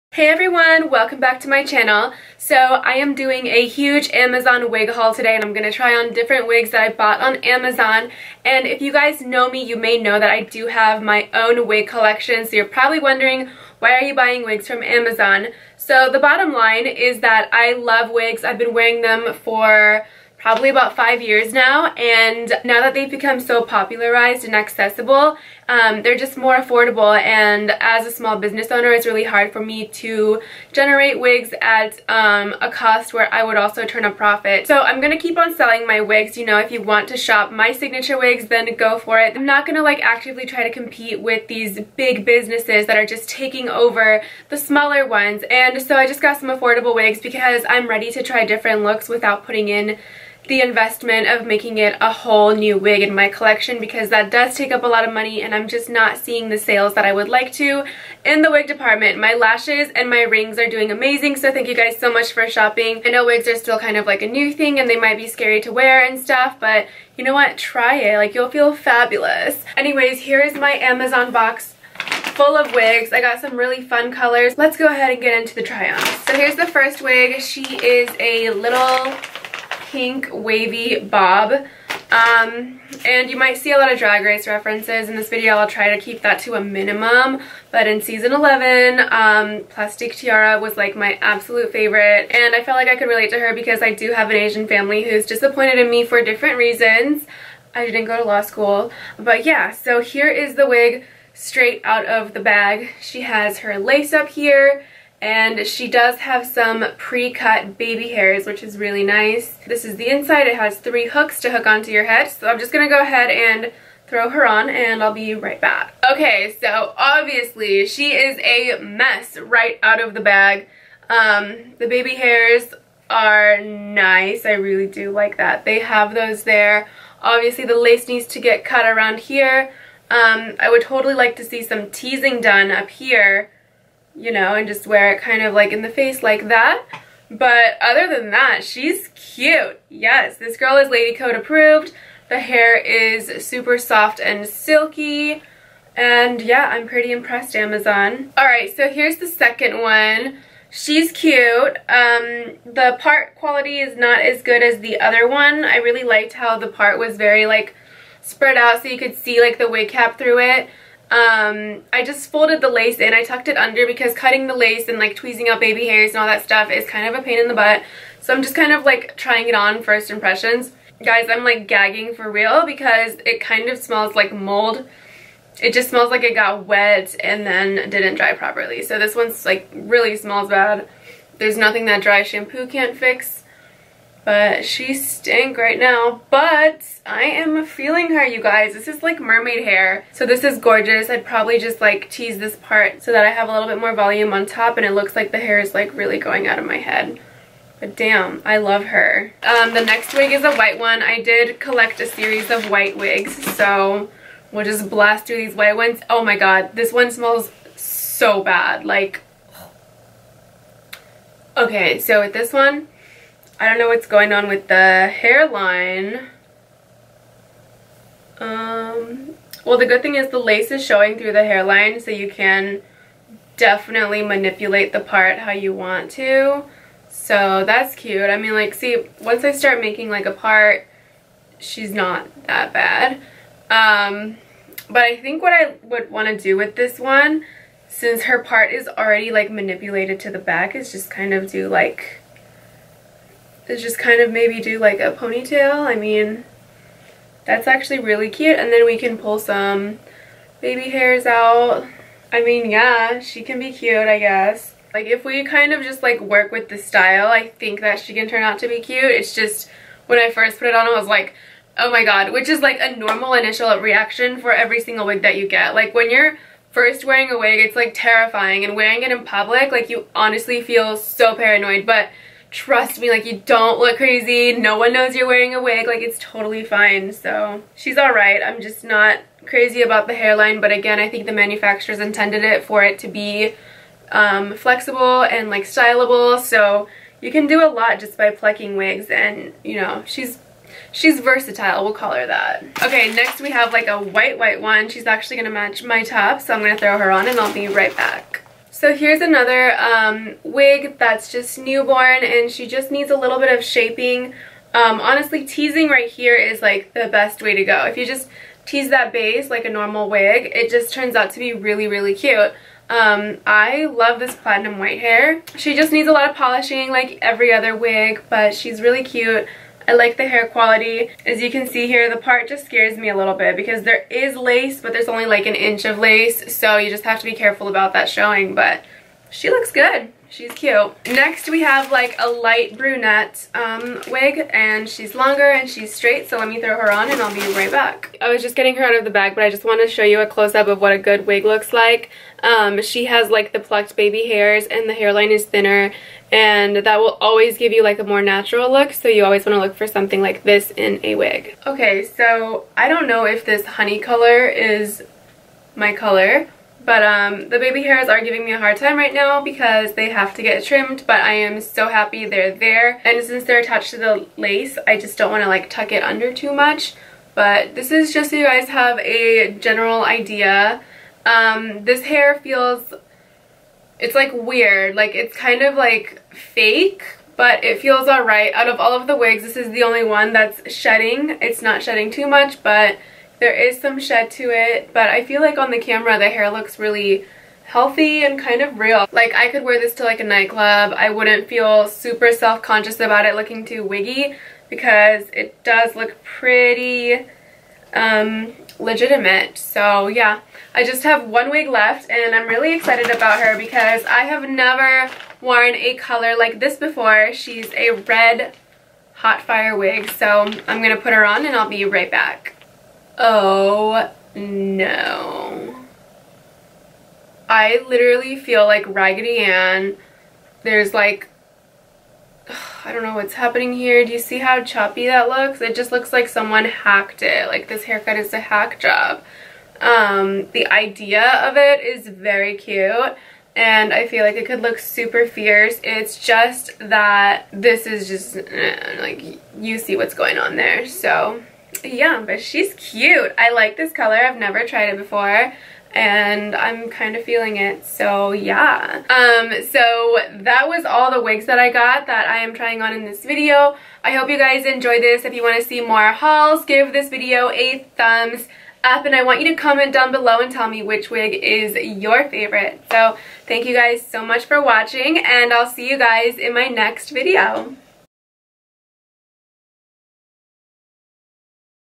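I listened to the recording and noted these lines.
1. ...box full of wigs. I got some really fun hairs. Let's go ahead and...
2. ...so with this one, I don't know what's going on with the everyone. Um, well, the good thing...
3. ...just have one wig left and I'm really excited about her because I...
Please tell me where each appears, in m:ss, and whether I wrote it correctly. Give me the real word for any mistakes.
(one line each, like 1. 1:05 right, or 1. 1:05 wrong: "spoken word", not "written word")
1. 1:11 wrong: "colors", not "hairs"
2. 3:31 wrong: "hairline", not "everyone"
3. 6:40 right.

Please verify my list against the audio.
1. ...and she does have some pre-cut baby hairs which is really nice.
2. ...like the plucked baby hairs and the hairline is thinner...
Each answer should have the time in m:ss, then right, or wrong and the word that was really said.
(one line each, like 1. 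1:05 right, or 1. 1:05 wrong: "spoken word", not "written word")
1. 1:45 right
2. 5:43 right.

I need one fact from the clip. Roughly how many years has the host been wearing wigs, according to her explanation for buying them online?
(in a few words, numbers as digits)
5.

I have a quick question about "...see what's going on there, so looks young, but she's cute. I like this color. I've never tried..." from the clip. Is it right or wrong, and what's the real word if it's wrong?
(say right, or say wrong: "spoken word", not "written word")
right.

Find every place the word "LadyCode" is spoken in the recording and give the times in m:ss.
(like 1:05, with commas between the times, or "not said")
2:20.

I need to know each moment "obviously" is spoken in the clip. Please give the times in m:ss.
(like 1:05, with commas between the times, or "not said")
1:56, 2:07.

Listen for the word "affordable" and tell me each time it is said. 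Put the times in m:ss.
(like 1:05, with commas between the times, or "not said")
0:26, 0:46.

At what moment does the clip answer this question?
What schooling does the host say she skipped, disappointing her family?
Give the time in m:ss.
1:38.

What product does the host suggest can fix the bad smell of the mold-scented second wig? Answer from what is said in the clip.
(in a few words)
dry shampoo.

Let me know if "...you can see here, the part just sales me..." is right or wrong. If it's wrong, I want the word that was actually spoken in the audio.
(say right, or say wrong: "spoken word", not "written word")
wrong: "scares", not "sales".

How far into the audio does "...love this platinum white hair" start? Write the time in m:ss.
5:13.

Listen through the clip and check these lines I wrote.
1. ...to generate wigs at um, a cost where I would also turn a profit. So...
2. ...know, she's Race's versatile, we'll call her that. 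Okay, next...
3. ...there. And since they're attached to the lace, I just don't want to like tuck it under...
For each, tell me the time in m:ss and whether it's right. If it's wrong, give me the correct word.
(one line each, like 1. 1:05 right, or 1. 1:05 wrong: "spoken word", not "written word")
1. 0:30 right
2. 4:49 wrong: "She", not "Race"
3. 6:02 right.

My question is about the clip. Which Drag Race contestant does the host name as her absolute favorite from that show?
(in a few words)
Plastique Tiara.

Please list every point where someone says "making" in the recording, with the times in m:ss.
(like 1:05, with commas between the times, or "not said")
0:51, 3:49.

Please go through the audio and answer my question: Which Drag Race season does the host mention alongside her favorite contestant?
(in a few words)
11.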